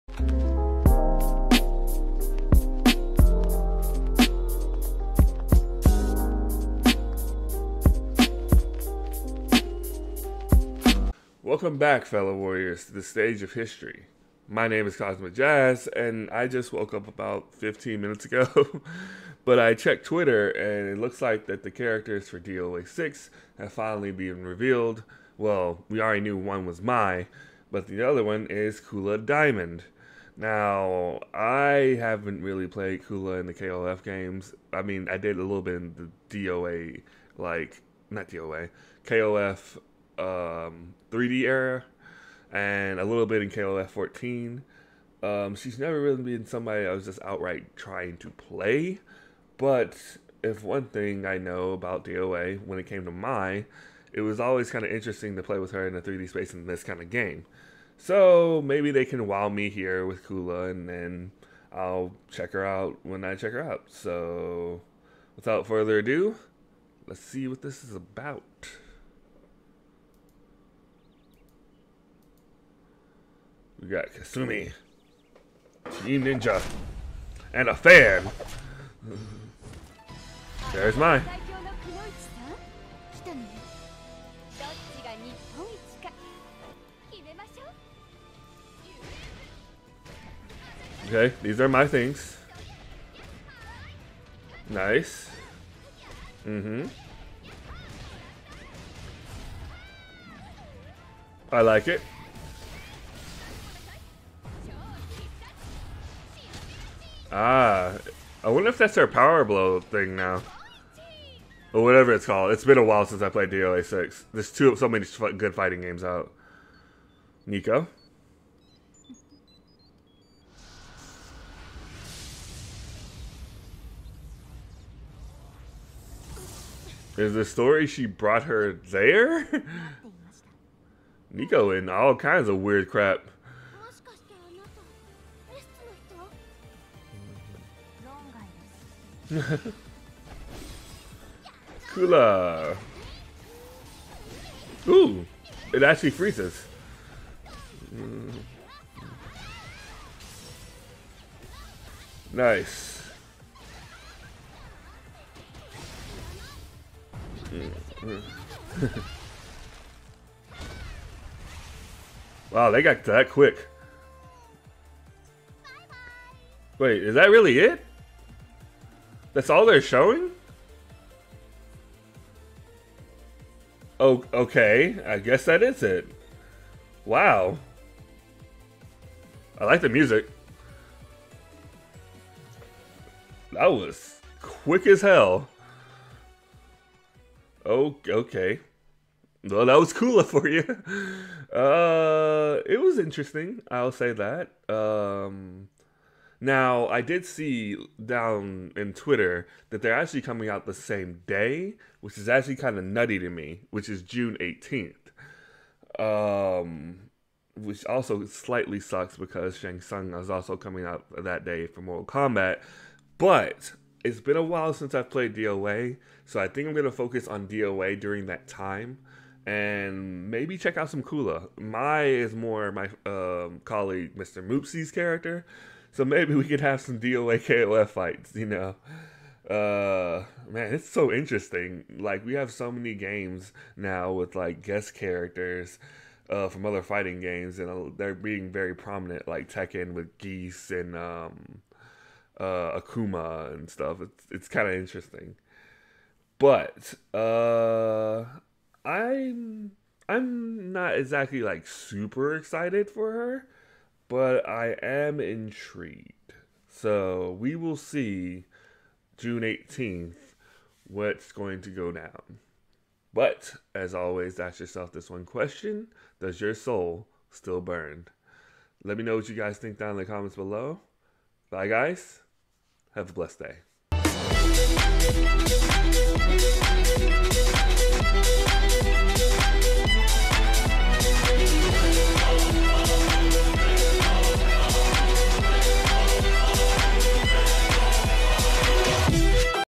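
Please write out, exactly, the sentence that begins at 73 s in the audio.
We got Kasumi, Team Ninja, and a fan.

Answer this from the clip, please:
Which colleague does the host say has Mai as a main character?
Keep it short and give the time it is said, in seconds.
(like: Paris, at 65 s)
Mr. Moopsie, at 224 s.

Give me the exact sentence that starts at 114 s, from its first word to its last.
There's two, so many good fighting games out.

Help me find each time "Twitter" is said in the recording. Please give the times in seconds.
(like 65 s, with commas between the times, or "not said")
20 s, 198 s.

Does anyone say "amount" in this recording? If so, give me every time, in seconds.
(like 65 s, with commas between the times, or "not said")
not said.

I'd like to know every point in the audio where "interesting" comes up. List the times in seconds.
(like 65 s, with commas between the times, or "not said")
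54 s, 192 s, 231 s, 244 s.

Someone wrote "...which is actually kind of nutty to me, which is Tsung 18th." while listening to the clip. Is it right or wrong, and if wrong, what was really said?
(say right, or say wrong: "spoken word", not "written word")
wrong: "June", not "Tsung".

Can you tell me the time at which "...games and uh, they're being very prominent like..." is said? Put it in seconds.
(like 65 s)
237 s.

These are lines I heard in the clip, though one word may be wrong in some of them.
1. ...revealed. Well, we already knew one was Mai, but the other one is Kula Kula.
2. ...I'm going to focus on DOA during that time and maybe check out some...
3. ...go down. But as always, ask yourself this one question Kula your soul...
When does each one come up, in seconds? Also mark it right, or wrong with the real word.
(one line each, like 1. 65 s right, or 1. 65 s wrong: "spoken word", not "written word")
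1. 24 s wrong: "Diamond", not "Kula"
2. 216 s right
3. 261 s wrong: "Does", not "Kula".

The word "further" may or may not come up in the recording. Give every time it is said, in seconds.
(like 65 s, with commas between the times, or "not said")
65 s.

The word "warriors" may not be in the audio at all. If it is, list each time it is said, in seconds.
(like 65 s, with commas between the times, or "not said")
12 s.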